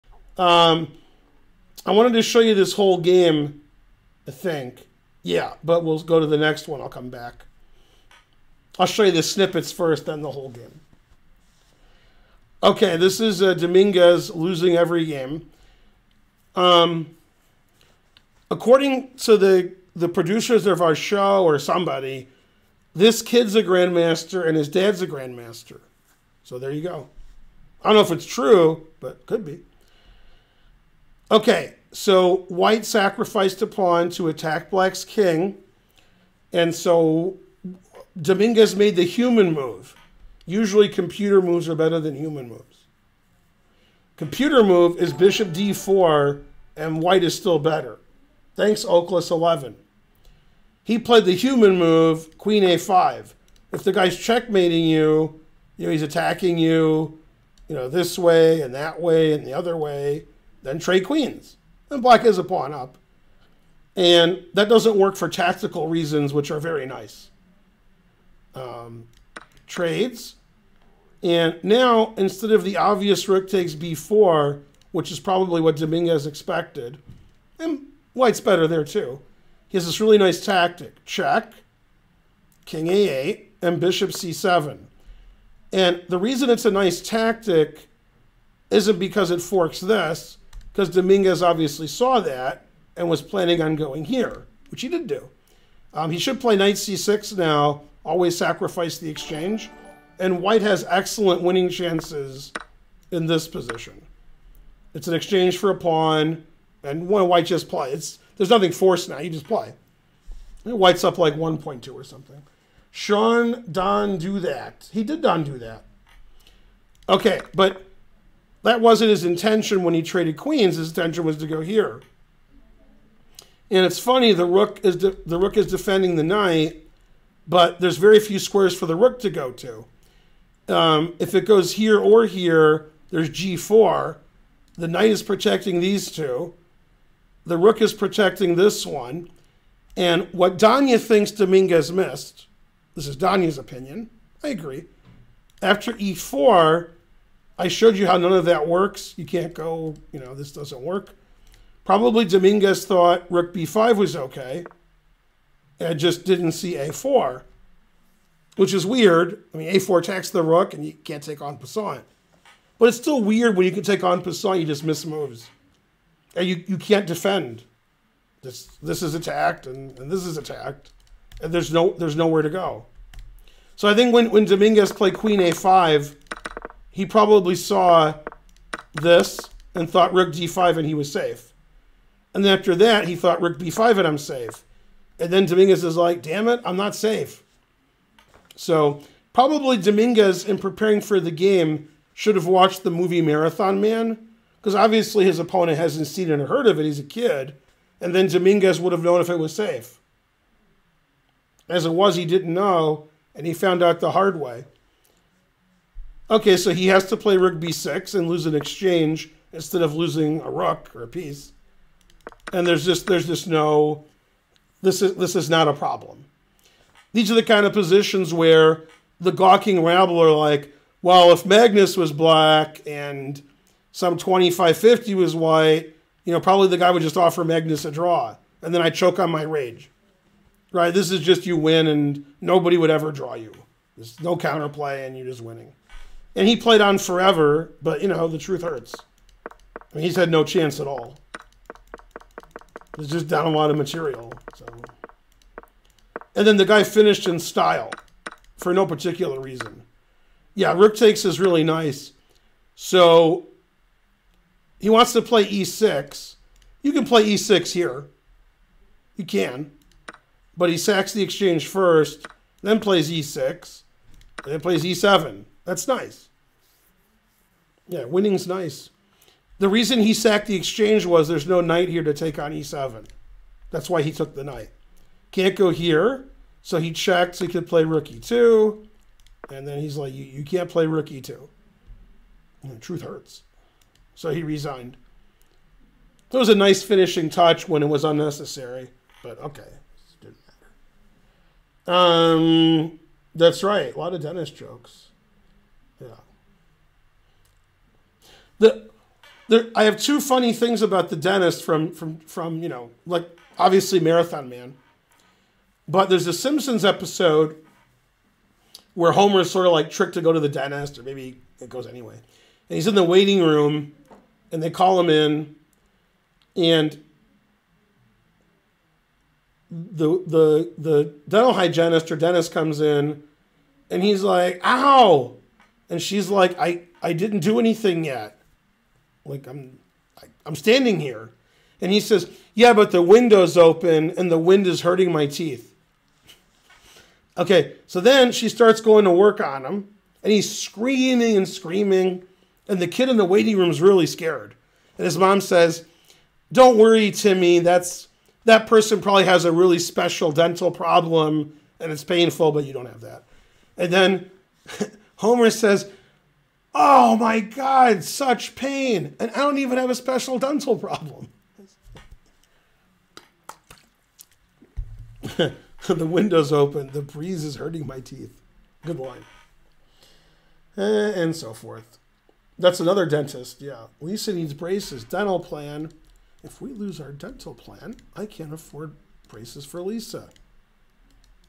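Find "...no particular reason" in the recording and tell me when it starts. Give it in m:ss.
4:08.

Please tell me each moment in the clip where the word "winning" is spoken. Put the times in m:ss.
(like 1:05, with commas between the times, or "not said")
1:41, 3:55, 4:28.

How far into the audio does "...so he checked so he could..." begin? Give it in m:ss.
4:36.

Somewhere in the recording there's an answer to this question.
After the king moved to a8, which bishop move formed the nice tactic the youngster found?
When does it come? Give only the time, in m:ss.
1:23.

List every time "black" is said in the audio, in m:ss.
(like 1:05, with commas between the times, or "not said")
0:34, 1:02, 3:42.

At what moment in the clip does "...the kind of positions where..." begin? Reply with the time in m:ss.
3:37.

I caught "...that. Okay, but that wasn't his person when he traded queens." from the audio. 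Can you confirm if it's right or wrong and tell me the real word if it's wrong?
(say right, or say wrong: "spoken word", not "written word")
wrong: "intention", not "person".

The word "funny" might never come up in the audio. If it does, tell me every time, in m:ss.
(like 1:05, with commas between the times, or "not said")
2:03, 5:00.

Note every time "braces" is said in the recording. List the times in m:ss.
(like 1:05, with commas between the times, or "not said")
6:14, 6:19.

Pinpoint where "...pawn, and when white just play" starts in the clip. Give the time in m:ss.
1:45.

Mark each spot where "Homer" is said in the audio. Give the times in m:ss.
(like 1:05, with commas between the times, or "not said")
5:09, 5:55.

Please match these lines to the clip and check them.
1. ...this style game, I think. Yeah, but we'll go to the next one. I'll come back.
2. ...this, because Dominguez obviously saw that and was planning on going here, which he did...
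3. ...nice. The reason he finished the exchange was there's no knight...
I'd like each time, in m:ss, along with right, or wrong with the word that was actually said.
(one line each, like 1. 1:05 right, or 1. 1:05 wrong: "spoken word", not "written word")
1. 0:02 wrong: "whole", not "style"
2. 1:29 right
3. 4:28 wrong: "sacked", not "finished".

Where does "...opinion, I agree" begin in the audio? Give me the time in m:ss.
2:23.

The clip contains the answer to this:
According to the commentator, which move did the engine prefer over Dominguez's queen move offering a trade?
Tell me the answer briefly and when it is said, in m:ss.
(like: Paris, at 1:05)
Bishop d4, at 0:45.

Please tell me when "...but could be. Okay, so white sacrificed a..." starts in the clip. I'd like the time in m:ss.
0:29.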